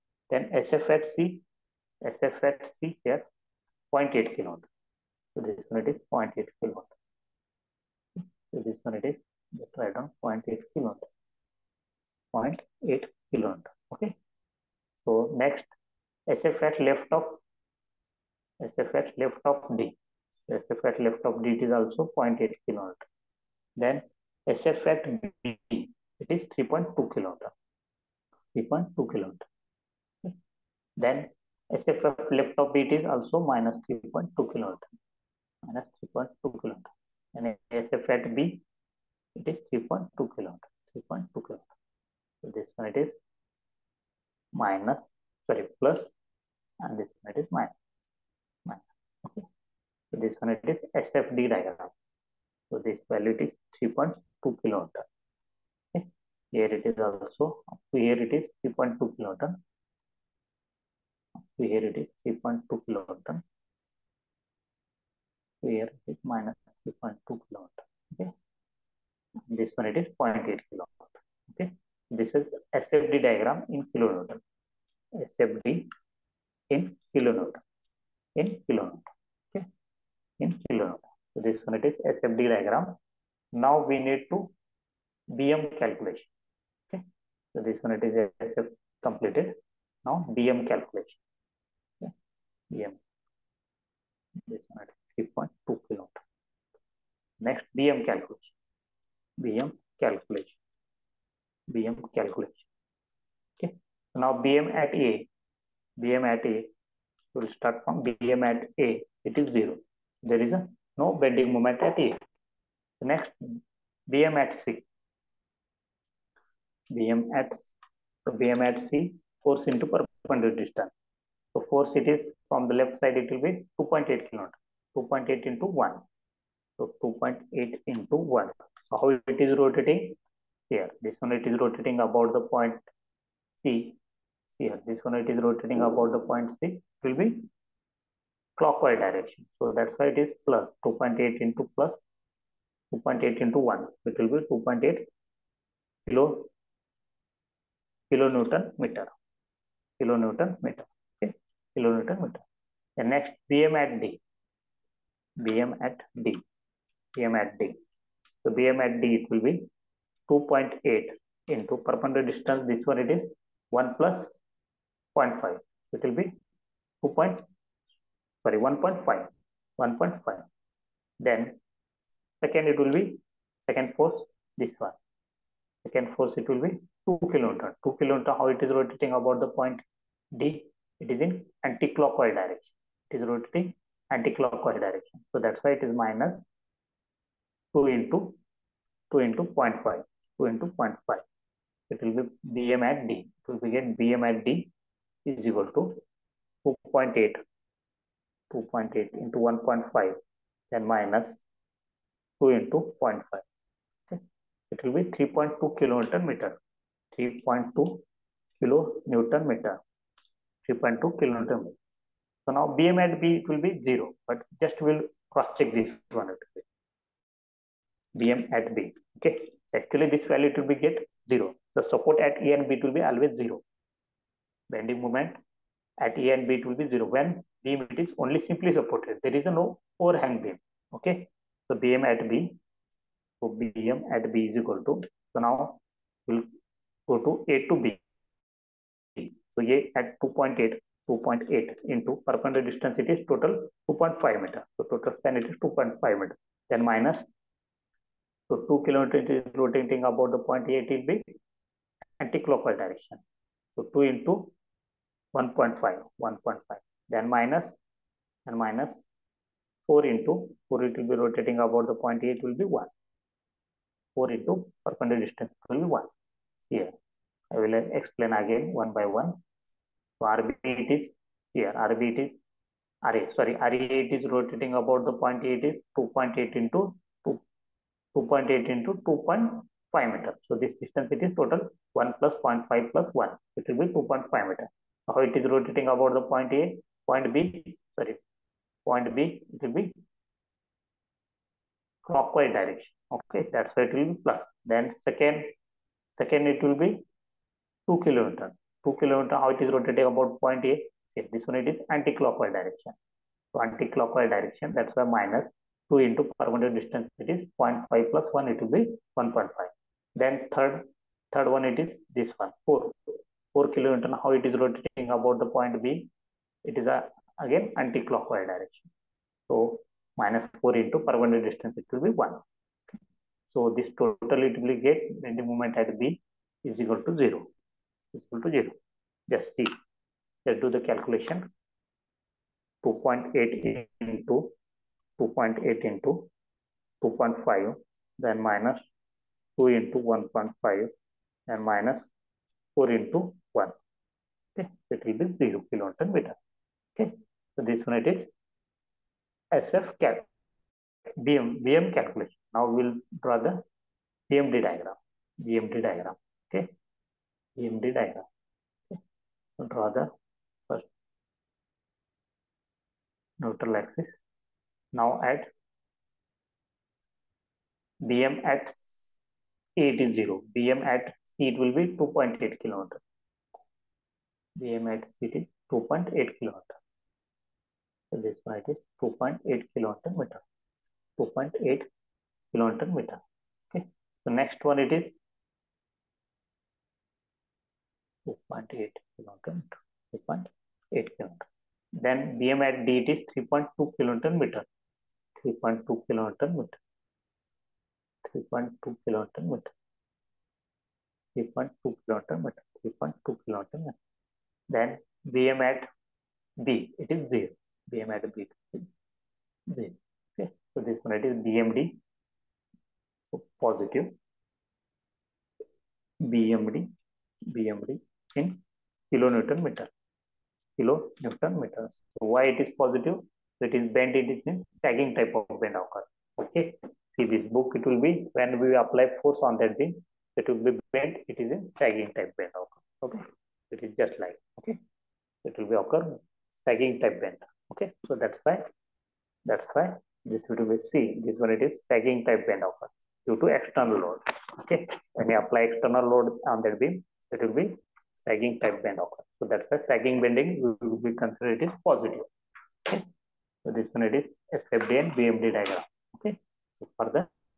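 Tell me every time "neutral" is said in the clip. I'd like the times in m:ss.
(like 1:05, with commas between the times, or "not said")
6:03.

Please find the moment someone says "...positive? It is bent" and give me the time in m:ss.
7:02.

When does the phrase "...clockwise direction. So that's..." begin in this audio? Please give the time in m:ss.
2:18.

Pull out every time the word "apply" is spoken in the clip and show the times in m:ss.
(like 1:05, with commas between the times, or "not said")
7:08, 7:25.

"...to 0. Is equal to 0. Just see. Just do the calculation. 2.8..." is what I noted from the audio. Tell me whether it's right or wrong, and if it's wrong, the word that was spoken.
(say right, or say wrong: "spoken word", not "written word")
right.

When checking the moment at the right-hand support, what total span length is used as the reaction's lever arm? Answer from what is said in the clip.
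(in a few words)
2.5 meter.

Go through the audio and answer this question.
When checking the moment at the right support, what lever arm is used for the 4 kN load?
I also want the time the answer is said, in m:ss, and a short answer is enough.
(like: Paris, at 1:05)
1, at 5:20.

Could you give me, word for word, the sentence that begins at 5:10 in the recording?
Then third, third one it is this one, 4.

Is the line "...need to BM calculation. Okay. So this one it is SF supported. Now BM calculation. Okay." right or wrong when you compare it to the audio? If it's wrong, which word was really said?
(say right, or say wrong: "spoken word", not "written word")
wrong: "completed", not "supported".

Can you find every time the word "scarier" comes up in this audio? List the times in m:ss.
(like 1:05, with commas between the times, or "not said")
not said.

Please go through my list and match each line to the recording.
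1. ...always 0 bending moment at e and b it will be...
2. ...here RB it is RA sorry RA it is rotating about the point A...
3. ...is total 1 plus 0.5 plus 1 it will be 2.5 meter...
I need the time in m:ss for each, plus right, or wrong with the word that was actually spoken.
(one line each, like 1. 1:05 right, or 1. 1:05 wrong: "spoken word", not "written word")
1. 3:43 right
2. 4:31 right
3. 4:41 right.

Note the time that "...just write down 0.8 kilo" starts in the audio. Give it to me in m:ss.
0:09.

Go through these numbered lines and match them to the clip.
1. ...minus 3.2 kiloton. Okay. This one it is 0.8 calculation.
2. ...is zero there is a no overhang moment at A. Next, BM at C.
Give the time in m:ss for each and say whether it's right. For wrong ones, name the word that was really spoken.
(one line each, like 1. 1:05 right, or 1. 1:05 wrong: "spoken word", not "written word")
1. 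1:06 wrong: "kiloton", not "calculation"
2. 1:49 wrong: "bending", not "overhang".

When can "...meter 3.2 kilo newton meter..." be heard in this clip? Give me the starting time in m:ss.
3:26.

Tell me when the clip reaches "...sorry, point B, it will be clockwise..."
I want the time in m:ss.
4:47.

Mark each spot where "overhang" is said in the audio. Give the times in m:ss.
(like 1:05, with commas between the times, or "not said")
3:50.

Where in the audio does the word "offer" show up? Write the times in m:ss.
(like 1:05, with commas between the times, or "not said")
7:22, 7:29.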